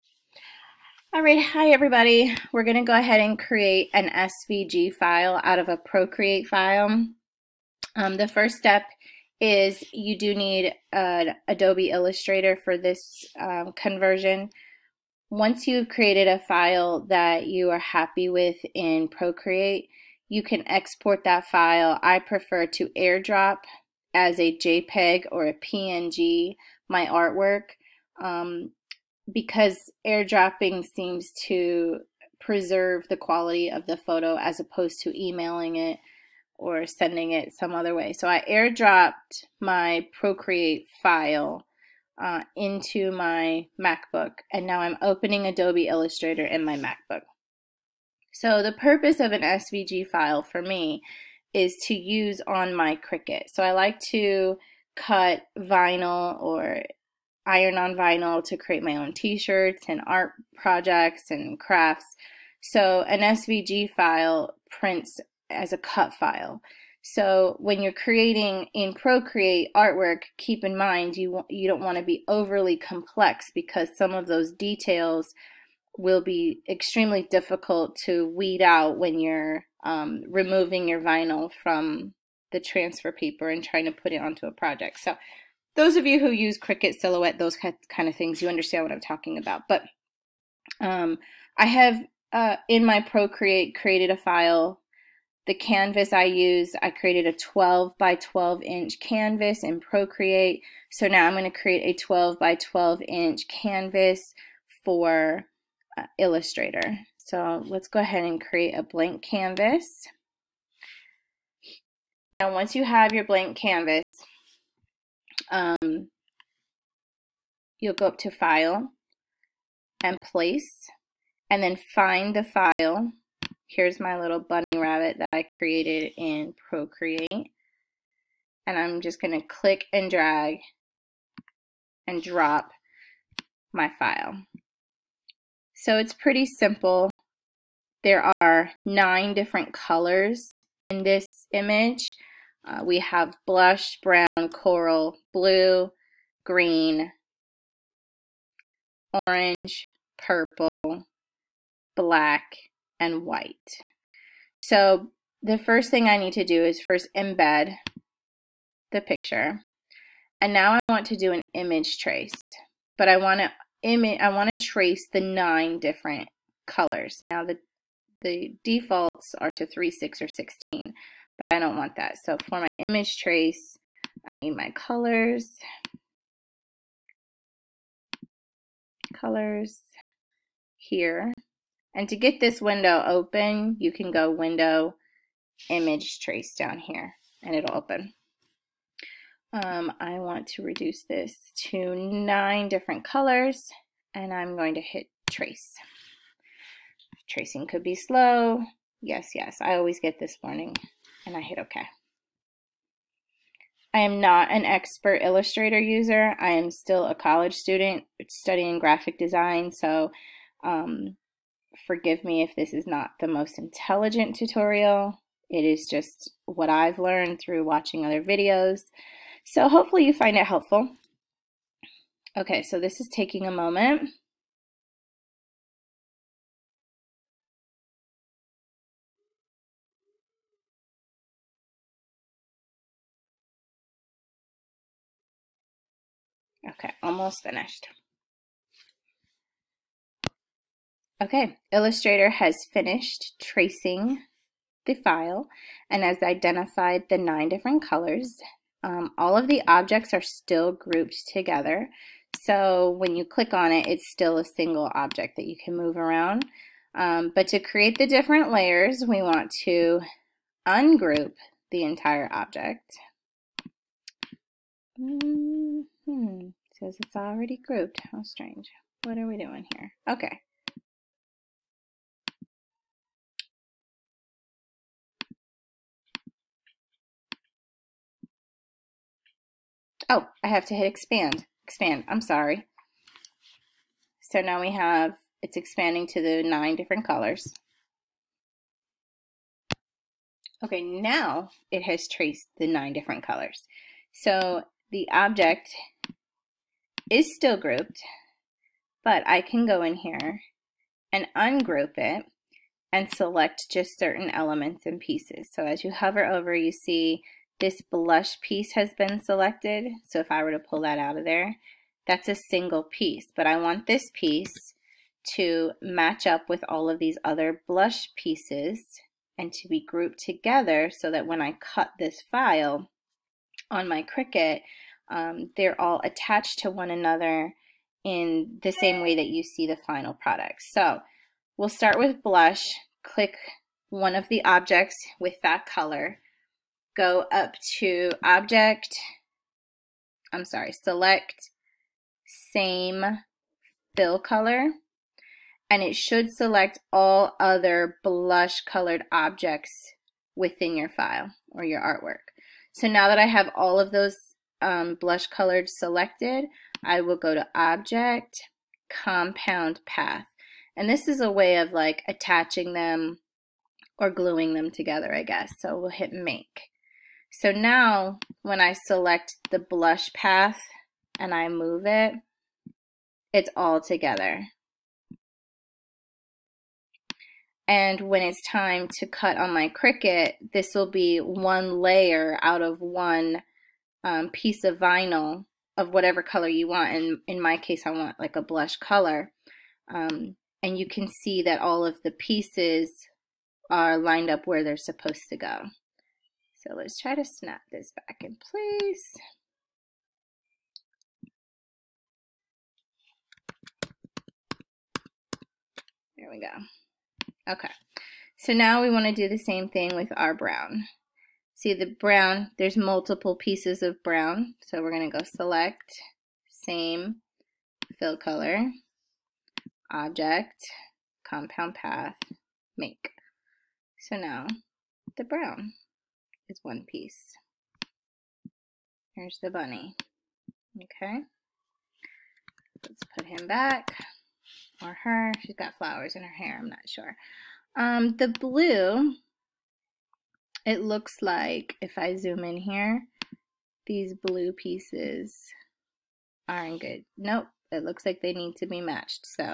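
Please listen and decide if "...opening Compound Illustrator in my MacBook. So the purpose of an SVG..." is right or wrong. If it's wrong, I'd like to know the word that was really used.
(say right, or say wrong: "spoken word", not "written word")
wrong: "Adobe", not "Compound".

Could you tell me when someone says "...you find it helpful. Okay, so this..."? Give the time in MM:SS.
03:40.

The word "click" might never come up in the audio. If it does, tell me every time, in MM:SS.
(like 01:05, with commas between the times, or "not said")
02:09, 04:13, 05:33.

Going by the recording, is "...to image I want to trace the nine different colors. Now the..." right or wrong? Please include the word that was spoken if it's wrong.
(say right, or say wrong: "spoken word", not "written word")
right.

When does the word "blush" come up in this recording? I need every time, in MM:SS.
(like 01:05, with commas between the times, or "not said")
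02:23, 05:07, 05:17, 05:32, 05:48, 05:54, 06:09, 06:28.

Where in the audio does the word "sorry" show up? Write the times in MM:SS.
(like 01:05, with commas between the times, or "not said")
04:42, 05:40.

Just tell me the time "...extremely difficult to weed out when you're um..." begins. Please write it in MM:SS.
01:16.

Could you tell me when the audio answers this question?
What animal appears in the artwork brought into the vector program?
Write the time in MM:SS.
02:04.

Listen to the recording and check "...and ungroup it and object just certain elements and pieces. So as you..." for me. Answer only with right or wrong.
wrong.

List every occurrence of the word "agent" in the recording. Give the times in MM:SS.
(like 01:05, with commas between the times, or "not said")
not said.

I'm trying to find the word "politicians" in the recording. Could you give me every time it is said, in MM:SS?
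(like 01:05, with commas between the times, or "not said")
not said.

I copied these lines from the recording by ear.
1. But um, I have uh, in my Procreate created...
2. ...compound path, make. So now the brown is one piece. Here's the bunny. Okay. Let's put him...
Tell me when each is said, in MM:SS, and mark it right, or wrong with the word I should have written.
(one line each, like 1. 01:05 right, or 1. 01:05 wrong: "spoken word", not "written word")
1. 01:29 right
2. 07:01 right.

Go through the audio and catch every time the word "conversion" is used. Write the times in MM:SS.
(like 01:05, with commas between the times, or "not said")
00:13.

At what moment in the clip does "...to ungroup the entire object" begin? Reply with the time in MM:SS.
04:19.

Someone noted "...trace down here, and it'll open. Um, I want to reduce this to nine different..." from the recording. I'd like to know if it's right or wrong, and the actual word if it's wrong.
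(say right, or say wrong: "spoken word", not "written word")
right.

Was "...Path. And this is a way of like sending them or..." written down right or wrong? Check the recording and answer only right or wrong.
wrong.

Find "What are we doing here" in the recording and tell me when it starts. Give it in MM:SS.
04:29.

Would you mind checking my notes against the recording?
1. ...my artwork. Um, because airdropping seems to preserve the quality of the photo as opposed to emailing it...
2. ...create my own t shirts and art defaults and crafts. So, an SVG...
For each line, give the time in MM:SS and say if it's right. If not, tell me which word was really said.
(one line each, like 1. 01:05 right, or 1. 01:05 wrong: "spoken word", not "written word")
1. 00:26 right
2. 00:58 wrong: "projects", not "defaults".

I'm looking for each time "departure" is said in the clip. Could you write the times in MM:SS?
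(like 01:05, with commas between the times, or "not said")
not said.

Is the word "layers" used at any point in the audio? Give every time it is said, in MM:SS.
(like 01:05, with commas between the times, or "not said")
04:18, 06:21.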